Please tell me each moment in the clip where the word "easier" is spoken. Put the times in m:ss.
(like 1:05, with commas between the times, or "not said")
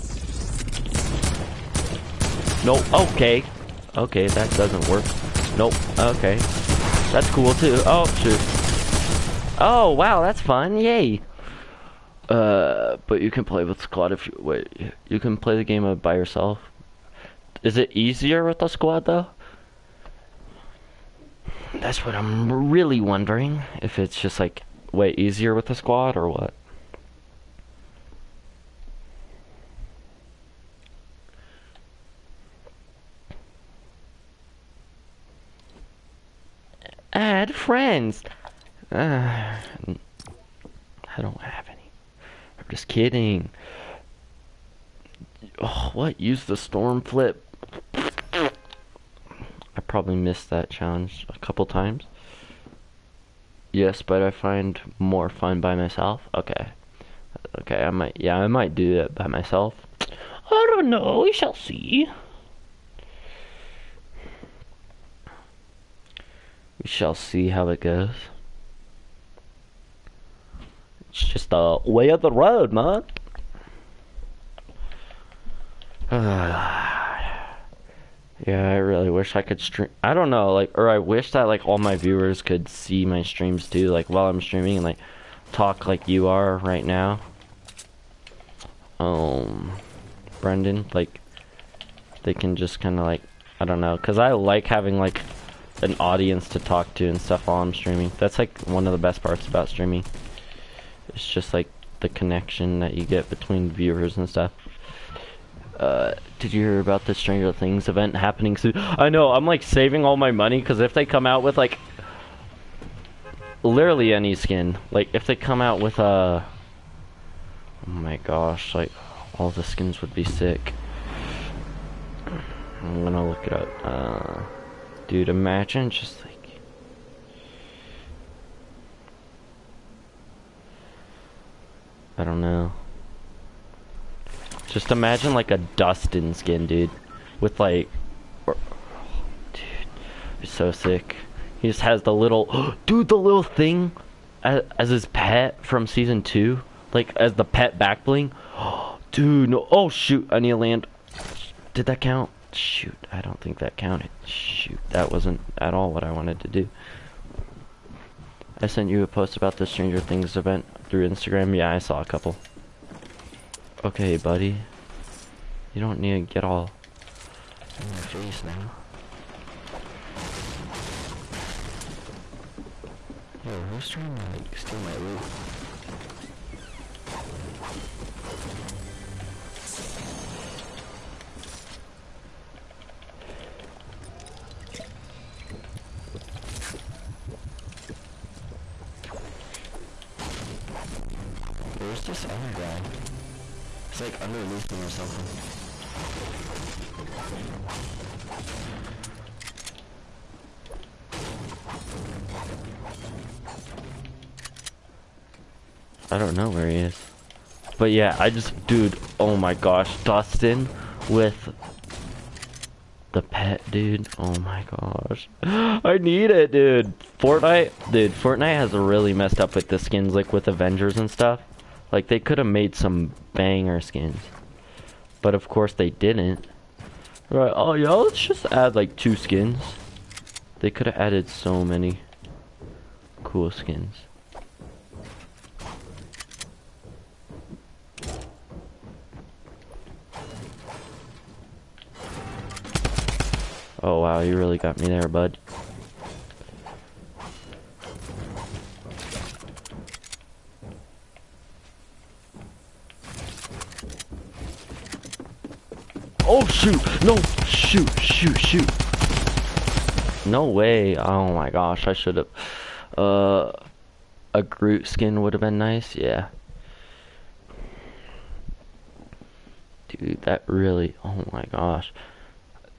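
0:17, 0:25.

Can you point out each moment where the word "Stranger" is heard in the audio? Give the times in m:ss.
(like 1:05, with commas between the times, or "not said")
1:47, 2:39.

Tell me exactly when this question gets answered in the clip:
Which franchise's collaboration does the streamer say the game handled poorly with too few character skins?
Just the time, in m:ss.
3:40.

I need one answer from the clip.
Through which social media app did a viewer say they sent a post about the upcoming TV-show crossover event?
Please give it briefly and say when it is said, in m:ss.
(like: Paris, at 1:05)
Instagram, at 2:41.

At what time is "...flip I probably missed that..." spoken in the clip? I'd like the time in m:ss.
0:47.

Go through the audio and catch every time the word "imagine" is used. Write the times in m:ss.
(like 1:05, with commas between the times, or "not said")
2:05, 2:14.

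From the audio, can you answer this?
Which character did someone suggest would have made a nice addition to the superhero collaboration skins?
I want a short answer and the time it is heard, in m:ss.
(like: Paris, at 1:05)
Groot, at 4:24.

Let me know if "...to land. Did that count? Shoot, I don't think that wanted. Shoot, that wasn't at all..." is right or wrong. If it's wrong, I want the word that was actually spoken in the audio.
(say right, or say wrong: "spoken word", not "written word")
wrong: "counted", not "wanted".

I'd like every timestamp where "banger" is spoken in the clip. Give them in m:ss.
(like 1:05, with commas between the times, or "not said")
3:43.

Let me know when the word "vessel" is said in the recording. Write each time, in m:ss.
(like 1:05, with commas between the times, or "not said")
not said.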